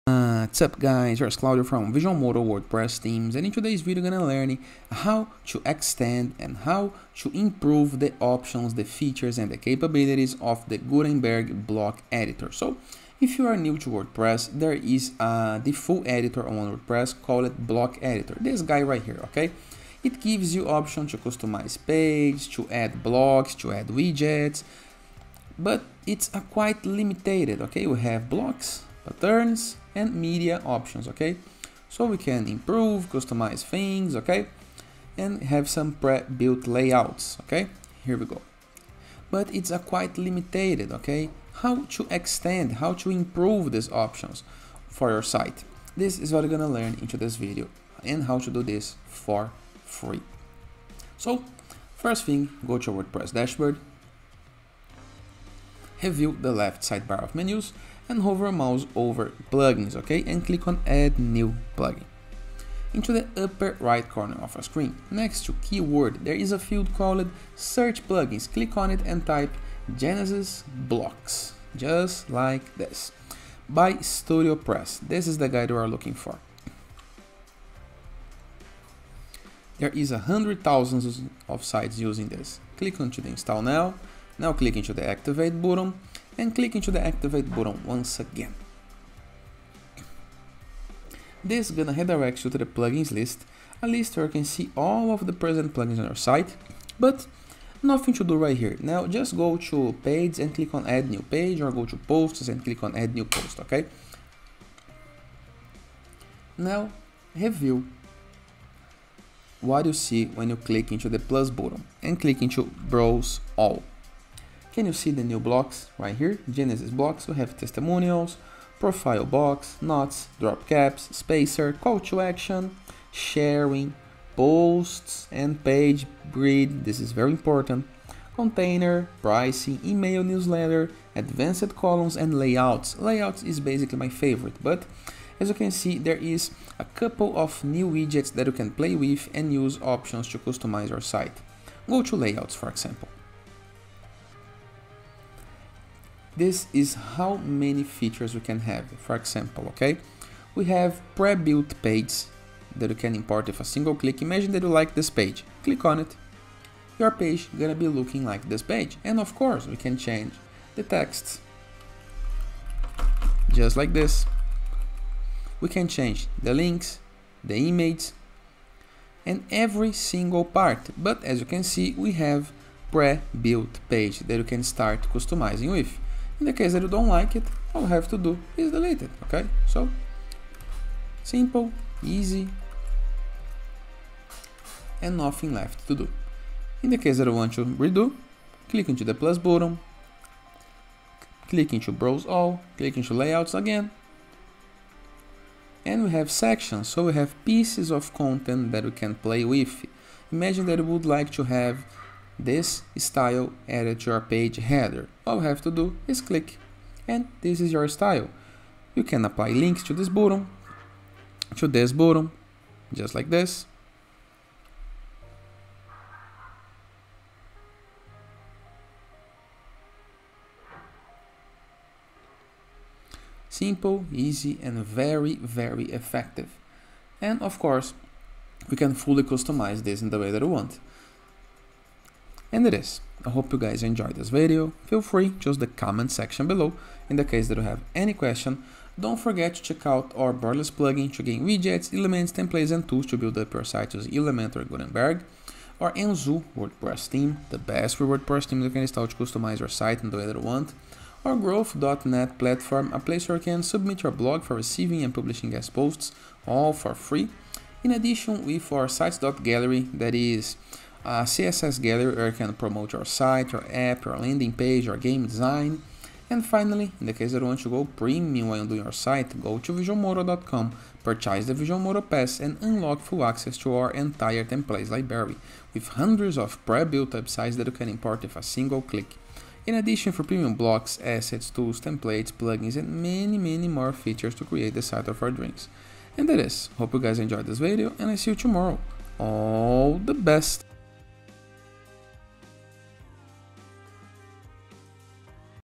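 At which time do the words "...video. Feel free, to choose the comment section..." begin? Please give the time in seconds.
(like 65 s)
234 s.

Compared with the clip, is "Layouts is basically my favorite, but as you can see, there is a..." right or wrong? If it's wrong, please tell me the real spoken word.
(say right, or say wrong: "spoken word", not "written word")
right.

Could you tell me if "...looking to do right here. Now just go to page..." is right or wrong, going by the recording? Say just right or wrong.
wrong.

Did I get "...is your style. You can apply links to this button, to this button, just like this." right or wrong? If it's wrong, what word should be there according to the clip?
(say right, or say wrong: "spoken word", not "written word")
right.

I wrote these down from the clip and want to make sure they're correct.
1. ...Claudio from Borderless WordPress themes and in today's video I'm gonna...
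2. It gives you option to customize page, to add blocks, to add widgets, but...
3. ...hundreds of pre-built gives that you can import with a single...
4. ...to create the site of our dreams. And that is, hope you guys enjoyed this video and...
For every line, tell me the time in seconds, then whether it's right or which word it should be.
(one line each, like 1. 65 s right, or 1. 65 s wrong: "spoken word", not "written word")
1. 1 s wrong: "Visualmodo", not "Borderless"
2. 20 s right
3. 275 s wrong: "websites", not "gives"
4. 284 s right.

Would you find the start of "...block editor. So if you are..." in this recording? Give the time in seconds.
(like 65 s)
11 s.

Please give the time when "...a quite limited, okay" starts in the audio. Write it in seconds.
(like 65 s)
39 s.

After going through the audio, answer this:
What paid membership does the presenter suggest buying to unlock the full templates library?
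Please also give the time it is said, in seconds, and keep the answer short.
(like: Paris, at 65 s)
Visual Modo Pass, at 271 s.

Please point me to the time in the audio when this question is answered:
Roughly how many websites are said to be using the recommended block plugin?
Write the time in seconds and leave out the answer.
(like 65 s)
80 s.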